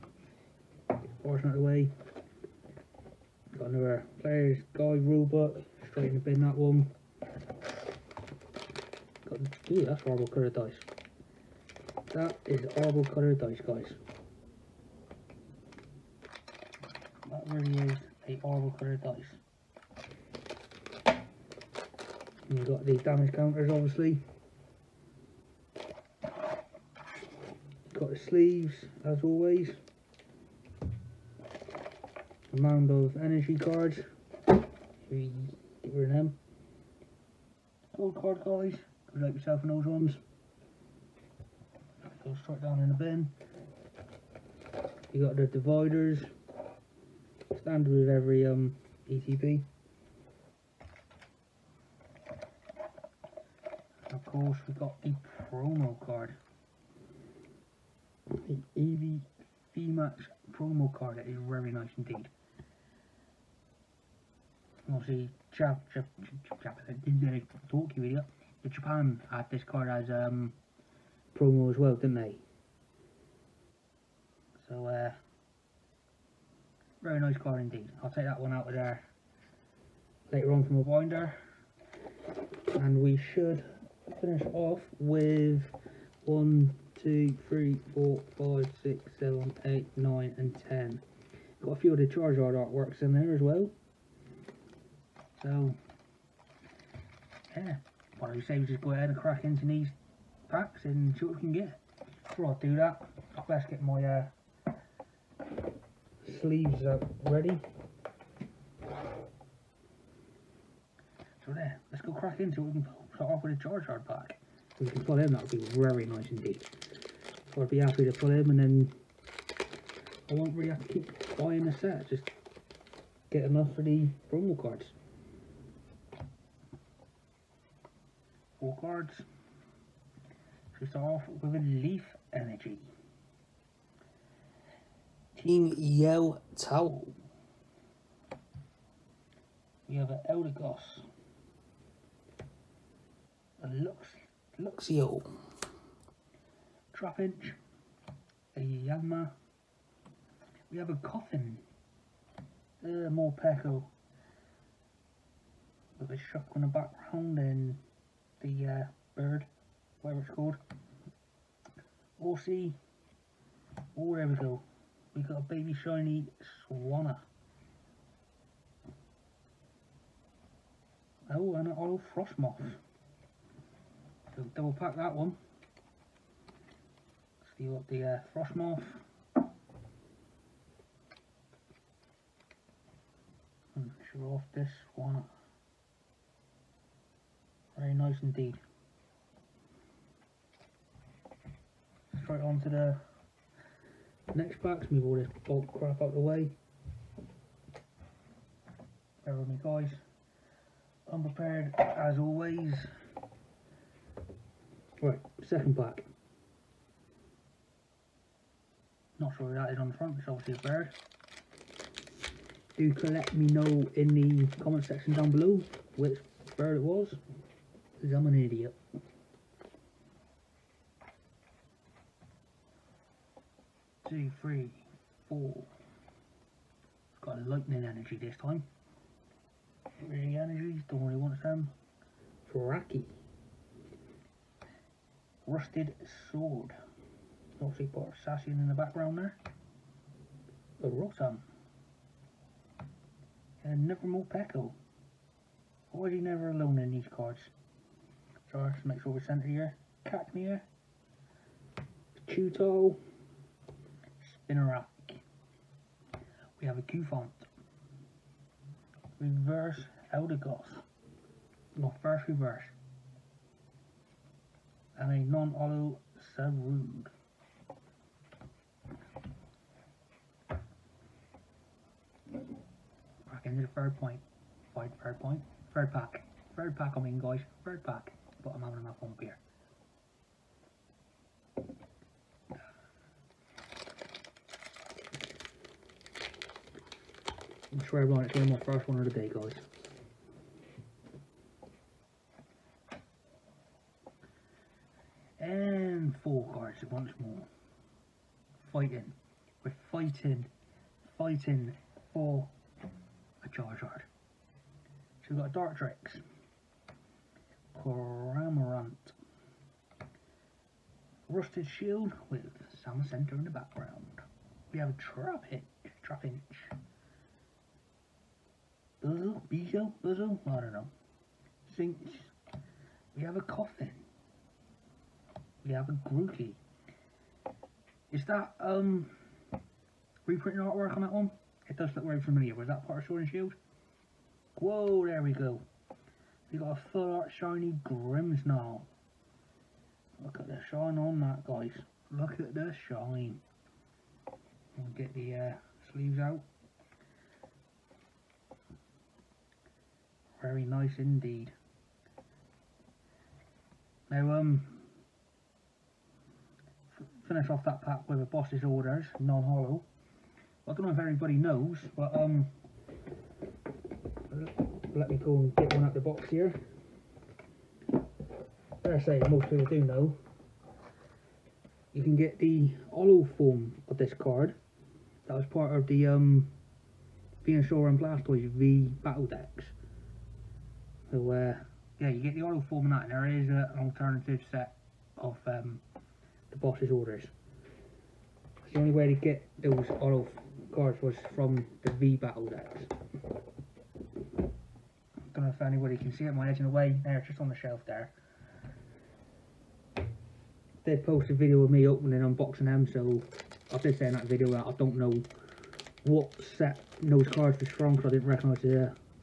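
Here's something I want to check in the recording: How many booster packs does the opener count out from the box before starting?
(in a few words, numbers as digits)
10.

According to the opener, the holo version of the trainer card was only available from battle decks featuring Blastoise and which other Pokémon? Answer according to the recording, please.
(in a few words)
Venusaur.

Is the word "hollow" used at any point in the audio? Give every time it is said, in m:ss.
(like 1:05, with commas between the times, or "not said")
5:59, 6:12.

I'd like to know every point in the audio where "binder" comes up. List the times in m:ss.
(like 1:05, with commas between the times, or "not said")
1:20.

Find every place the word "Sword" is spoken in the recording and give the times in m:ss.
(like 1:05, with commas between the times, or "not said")
3:56, 5:33.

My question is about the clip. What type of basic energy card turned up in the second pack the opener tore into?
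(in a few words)
Lightning.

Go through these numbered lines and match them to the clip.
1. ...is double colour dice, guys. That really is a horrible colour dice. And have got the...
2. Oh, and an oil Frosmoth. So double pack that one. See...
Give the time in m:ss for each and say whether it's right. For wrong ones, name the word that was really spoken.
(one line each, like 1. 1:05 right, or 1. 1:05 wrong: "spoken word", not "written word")
1. 0:12 wrong: "horrible", not "double"
2. 2:51 right.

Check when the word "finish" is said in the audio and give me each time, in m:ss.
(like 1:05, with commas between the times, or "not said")
1:24, 5:57.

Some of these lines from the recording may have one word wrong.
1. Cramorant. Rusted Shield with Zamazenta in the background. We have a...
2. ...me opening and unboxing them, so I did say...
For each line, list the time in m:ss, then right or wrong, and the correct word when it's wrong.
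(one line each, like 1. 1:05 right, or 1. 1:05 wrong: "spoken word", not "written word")
1. 5:07 right
2. 6:41 right.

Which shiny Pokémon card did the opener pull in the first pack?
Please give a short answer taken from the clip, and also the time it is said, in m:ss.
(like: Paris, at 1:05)
Swanna, at 2:46.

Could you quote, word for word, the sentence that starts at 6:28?
The only way to get those oil cards was from the V battle decks.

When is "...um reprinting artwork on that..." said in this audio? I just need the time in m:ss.
5:28.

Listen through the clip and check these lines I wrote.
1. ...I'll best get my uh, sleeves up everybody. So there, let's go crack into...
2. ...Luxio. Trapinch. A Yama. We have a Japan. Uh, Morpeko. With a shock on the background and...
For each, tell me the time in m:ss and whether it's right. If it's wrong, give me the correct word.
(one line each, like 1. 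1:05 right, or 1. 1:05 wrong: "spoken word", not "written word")
1. 1:43 wrong: "ready", not "everybody"
2. 2:24 wrong: "Koffing", not "Japan".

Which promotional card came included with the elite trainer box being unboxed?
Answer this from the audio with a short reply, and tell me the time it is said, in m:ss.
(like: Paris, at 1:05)
Eevee VMAX, at 0:58.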